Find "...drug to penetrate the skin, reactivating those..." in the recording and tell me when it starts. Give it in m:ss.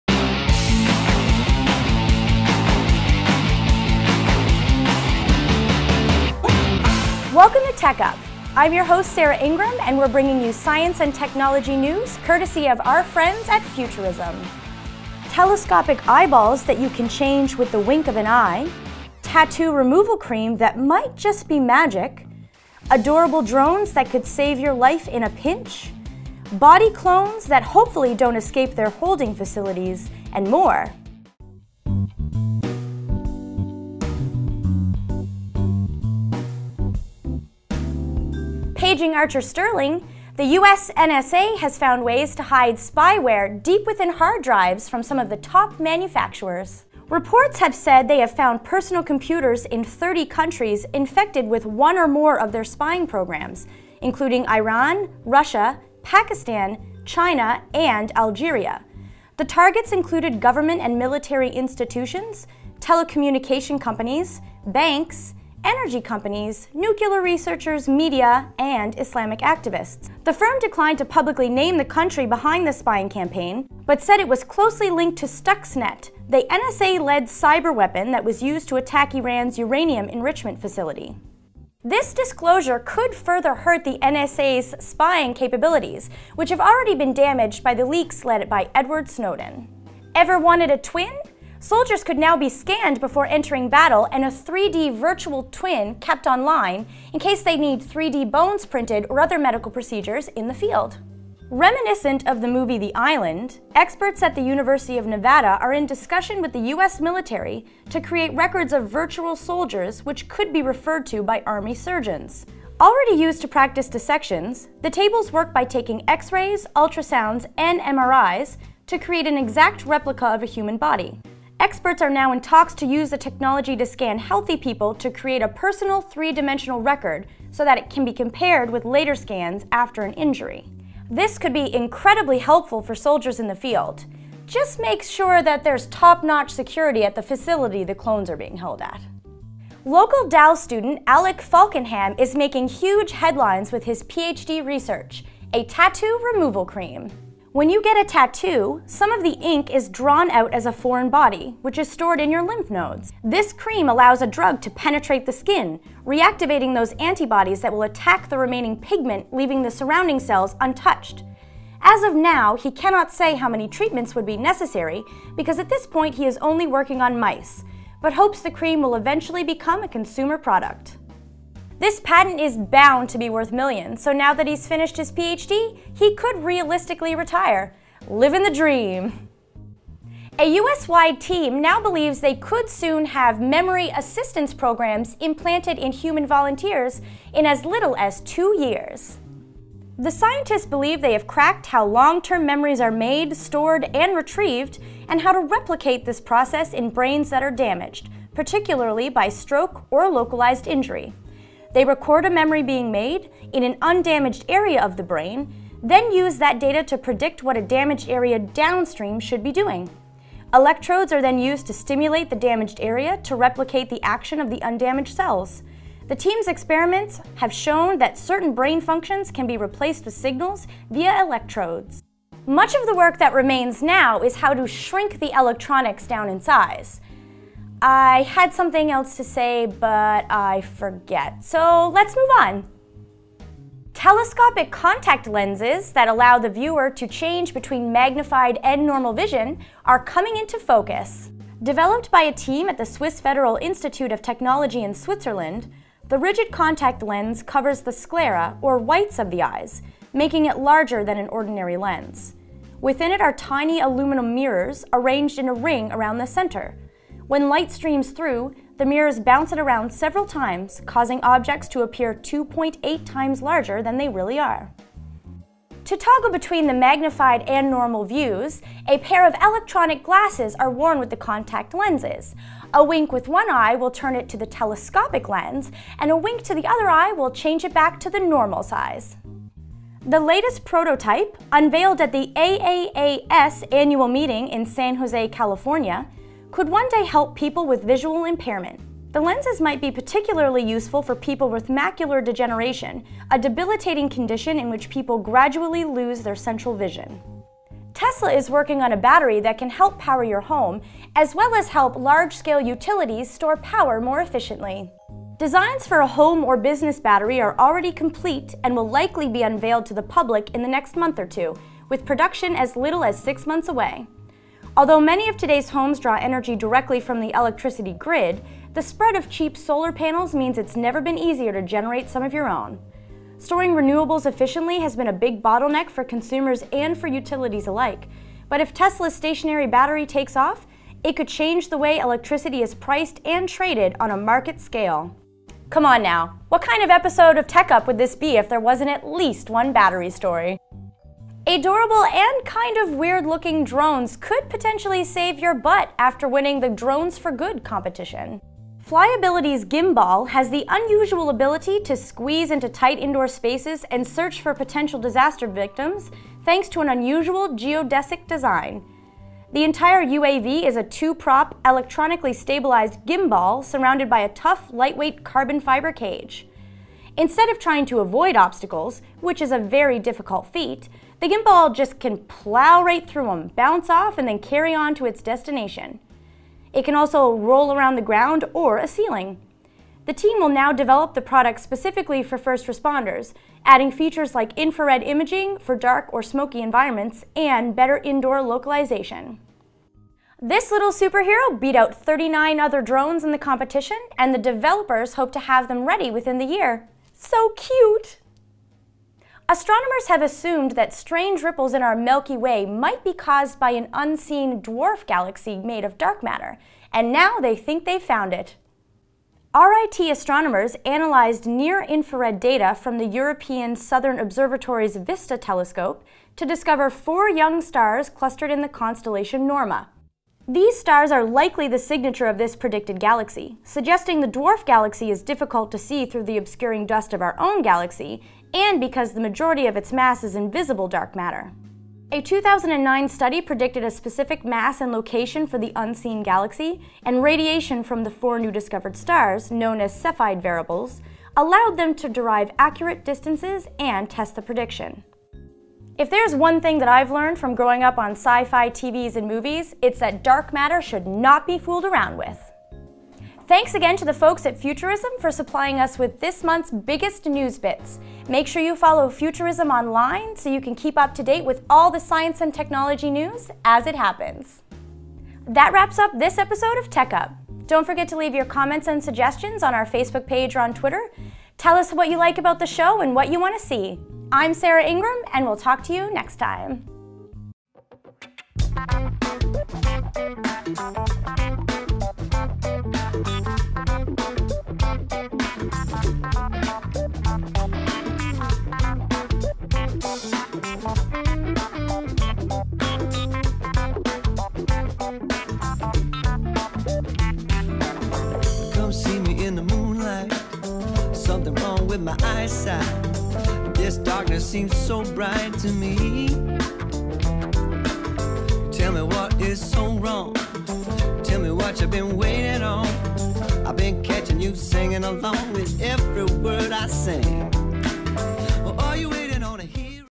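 2:34.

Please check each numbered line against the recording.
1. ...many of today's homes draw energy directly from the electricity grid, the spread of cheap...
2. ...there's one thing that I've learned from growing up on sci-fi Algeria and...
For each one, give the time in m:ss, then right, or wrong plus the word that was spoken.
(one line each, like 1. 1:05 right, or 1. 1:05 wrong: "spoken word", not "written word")
1. 5:15 right
2. 7:26 wrong: "TVs", not "Algeria".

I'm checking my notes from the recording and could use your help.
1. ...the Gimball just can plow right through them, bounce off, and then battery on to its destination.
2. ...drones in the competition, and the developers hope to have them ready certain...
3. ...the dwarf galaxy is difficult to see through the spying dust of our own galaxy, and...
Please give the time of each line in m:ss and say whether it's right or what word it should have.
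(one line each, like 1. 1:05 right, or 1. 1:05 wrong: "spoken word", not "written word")
1. 6:11 wrong: "carry", not "battery"
2. 6:32 wrong: "within", not "certain"
3. 7:04 wrong: "obscuring", not "spying".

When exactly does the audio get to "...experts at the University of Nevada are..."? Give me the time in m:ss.
1:43.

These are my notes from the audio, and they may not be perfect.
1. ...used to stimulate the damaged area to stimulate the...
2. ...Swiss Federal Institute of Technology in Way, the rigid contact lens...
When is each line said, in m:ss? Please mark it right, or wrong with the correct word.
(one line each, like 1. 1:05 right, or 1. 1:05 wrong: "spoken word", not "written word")
1. 3:31 wrong: "replicate", not "stimulate"
2. 4:02 wrong: "Switzerland", not "Way".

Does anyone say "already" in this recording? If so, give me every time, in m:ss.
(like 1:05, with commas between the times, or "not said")
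1:26, 1:52, 5:07.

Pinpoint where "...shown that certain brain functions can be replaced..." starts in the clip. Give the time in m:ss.
3:37.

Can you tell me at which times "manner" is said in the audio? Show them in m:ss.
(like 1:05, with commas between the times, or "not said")
not said.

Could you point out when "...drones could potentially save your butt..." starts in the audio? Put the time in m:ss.
5:43.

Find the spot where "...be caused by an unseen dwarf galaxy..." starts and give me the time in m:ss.
6:43.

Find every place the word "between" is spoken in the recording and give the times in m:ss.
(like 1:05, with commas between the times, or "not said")
3:57, 4:26.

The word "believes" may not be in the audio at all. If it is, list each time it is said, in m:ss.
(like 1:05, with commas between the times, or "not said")
3:01, 3:10.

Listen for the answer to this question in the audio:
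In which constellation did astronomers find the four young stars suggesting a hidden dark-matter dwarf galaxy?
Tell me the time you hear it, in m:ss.
6:59.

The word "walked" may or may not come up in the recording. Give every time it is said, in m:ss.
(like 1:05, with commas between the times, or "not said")
not said.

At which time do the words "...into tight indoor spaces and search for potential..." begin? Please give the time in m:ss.
5:52.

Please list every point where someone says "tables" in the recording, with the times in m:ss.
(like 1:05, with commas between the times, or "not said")
1:54.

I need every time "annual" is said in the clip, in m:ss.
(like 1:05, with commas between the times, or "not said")
4:43.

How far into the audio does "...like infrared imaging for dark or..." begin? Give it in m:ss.
6:24.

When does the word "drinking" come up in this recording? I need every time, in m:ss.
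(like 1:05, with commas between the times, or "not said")
not said.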